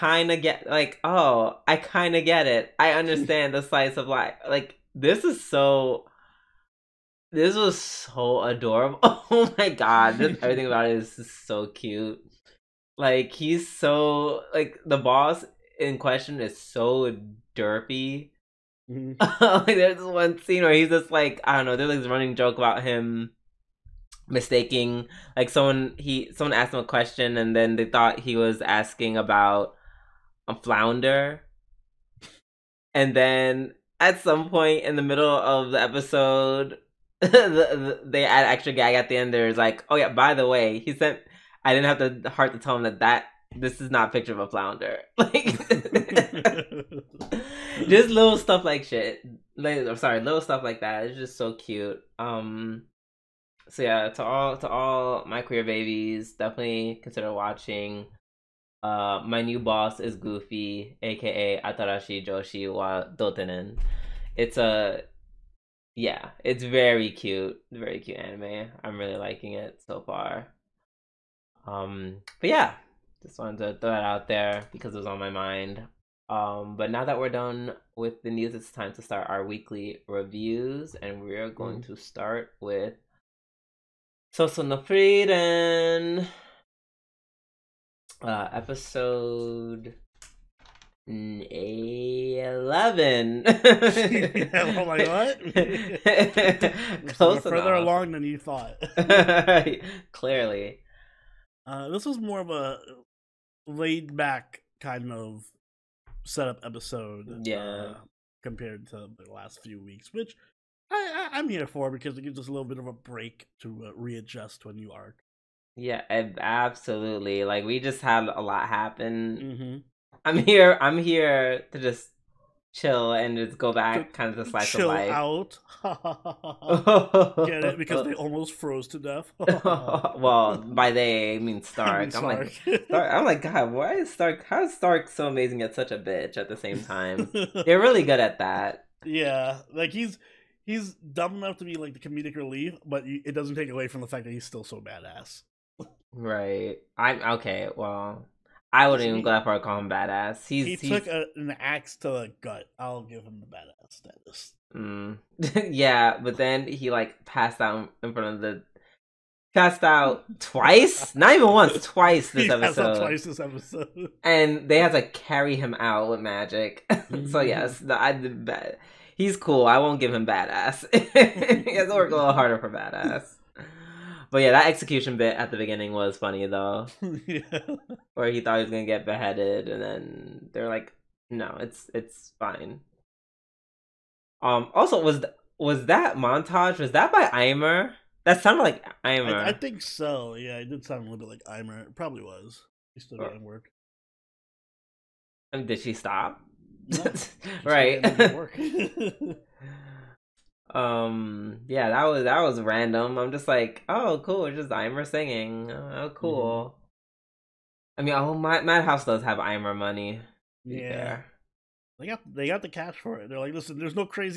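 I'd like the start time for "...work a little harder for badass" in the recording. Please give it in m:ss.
2:51.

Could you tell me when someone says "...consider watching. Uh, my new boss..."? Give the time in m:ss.
0:57.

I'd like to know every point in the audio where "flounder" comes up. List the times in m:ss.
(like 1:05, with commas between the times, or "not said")
0:30, 0:44.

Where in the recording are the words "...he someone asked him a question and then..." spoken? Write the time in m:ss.
0:25.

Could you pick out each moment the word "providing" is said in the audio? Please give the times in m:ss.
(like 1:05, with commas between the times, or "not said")
not said.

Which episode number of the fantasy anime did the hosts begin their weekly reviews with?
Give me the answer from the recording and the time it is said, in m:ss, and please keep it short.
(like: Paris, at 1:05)
11, at 1:31.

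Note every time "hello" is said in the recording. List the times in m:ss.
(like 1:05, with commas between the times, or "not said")
not said.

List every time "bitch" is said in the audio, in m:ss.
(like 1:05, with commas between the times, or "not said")
2:15.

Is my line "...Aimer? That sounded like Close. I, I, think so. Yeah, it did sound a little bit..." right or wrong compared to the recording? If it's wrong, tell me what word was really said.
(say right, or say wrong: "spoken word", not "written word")
wrong: "Aimer", not "Close".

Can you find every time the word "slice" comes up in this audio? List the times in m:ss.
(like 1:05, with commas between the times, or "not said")
0:03, 2:04.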